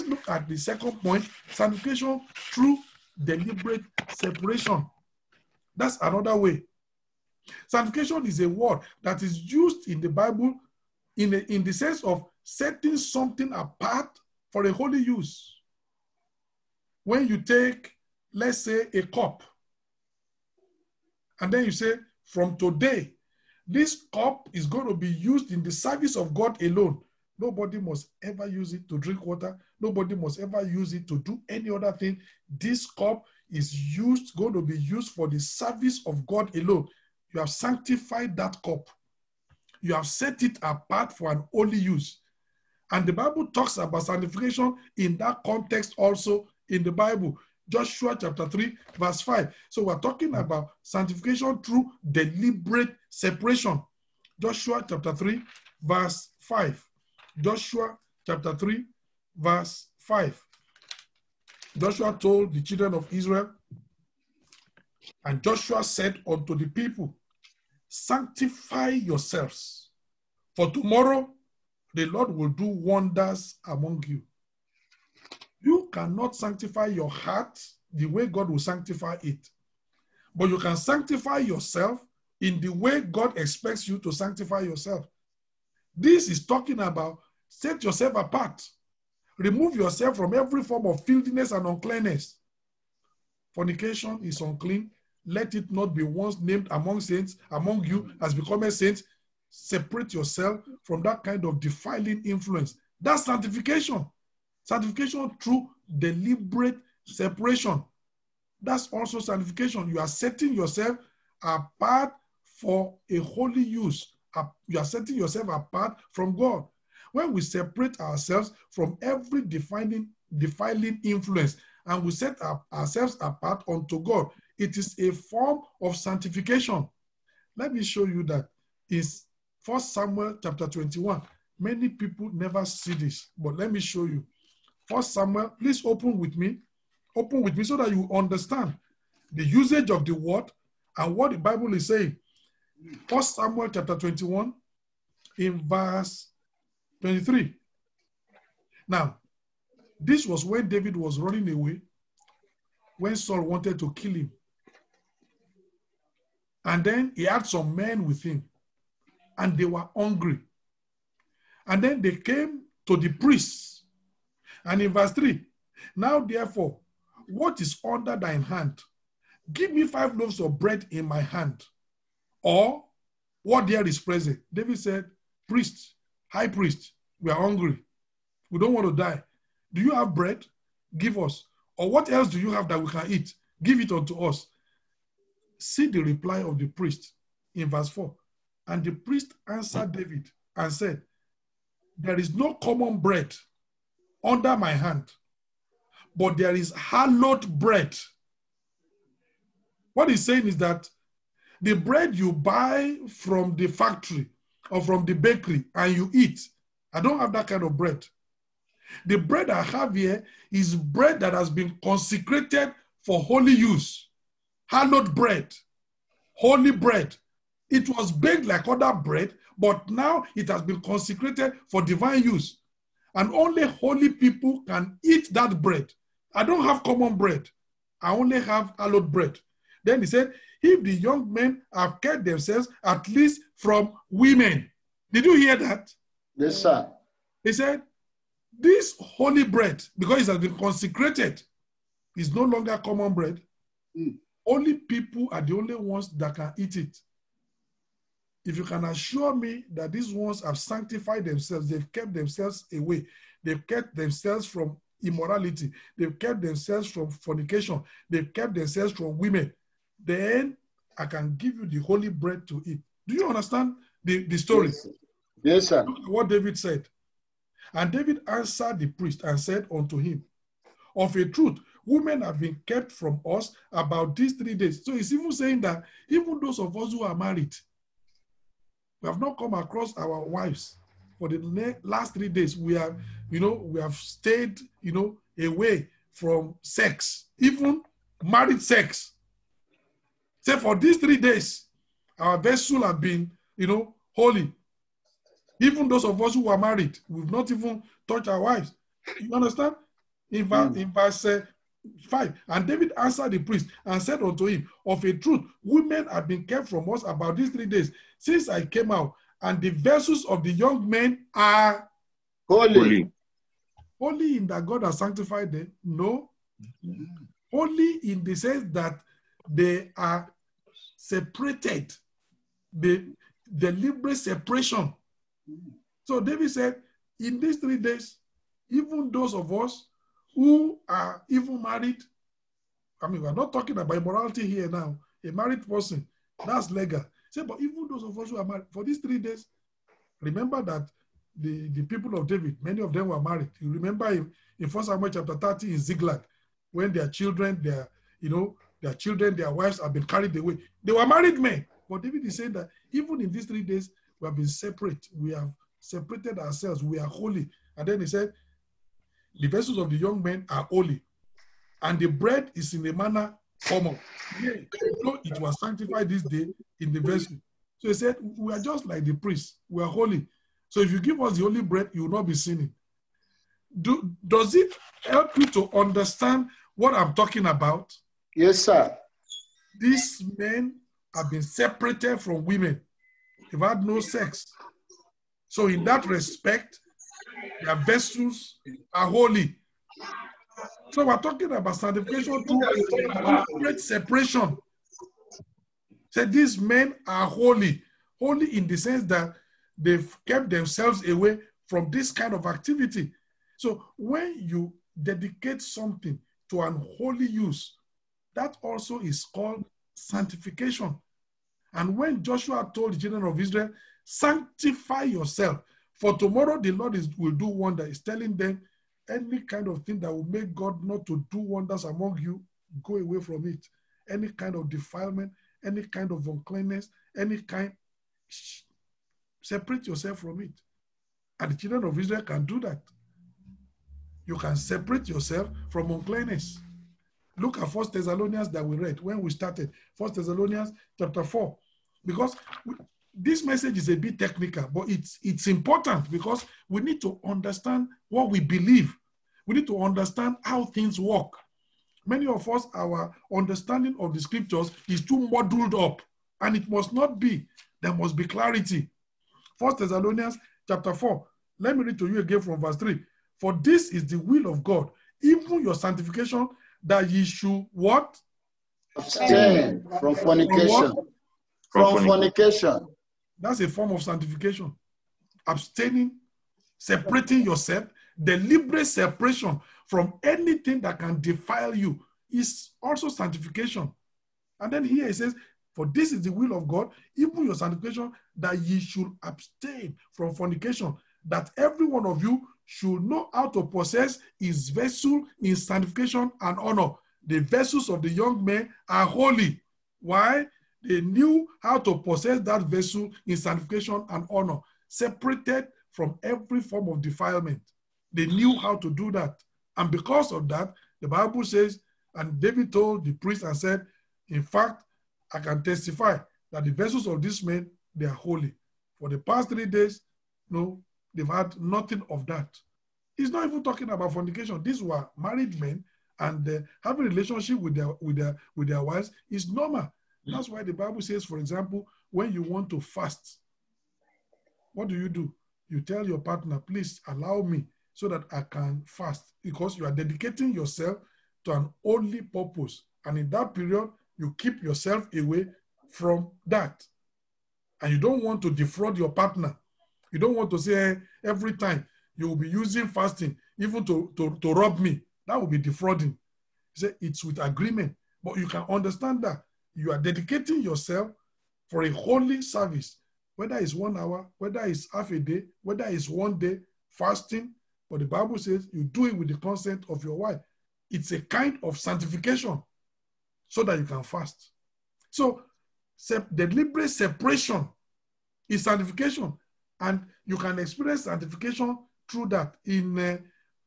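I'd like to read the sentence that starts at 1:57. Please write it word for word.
When we separate ourselves from every defining, defiling influence and we set ourselves apart unto God, it is a form of sanctification.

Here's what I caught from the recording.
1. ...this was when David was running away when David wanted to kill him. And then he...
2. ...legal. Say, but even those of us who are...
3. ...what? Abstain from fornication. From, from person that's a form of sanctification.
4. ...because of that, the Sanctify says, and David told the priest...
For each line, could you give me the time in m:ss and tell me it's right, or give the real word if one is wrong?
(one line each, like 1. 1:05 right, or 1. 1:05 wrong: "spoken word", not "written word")
1. 2:29 wrong: "Saul", not "David"
2. 5:36 right
3. 7:47 wrong: "fornication", not "person"
4. 8:29 wrong: "Bible", not "Sanctify".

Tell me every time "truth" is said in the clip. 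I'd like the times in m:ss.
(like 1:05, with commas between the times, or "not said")
4:31, 5:05.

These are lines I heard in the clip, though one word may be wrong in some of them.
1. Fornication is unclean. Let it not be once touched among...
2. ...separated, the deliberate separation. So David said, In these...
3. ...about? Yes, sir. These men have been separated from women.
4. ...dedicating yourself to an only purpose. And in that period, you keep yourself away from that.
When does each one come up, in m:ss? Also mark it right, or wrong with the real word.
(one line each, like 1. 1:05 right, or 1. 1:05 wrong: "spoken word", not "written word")
1. 1:33 wrong: "named", not "touched"
2. 5:20 right
3. 6:17 right
4. 8:59 right.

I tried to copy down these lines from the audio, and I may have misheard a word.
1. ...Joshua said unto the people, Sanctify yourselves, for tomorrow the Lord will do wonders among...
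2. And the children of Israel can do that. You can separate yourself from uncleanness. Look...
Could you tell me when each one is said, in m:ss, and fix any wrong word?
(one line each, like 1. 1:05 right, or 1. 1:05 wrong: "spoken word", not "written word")
1. 1:05 right
2. 7:11 right.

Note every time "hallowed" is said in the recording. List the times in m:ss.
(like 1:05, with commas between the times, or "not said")
3:16, 3:34, 3:48.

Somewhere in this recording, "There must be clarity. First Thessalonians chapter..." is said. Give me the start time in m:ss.
7:37.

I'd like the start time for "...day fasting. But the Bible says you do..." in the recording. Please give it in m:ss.
9:26.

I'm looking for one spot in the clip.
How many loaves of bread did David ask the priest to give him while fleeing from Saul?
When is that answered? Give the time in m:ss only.
2:49.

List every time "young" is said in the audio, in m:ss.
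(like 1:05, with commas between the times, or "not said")
3:50, 5:10, 5:59, 8:18.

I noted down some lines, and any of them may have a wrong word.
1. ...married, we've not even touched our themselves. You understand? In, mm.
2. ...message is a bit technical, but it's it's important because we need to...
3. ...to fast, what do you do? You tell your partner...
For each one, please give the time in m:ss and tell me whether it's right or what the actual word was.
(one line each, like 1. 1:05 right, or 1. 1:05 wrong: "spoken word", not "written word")
1. 4:56 wrong: "wives", not "themselves"
2. 7:23 right
3. 8:52 right.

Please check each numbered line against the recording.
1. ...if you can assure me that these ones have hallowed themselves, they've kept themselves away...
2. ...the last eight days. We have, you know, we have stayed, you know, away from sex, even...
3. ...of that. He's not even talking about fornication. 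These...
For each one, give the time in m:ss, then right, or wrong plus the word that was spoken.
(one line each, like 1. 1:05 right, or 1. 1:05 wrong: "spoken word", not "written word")
1. 4:08 wrong: "sanctified", not "hallowed"
2. 4:41 wrong: "three", not "eight"
3. 8:42 right.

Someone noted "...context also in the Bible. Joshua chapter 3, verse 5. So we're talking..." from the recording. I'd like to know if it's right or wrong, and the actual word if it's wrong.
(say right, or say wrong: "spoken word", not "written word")
right.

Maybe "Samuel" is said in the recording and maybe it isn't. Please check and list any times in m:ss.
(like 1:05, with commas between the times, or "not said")
2:09, 2:15, 2:23, 5:44.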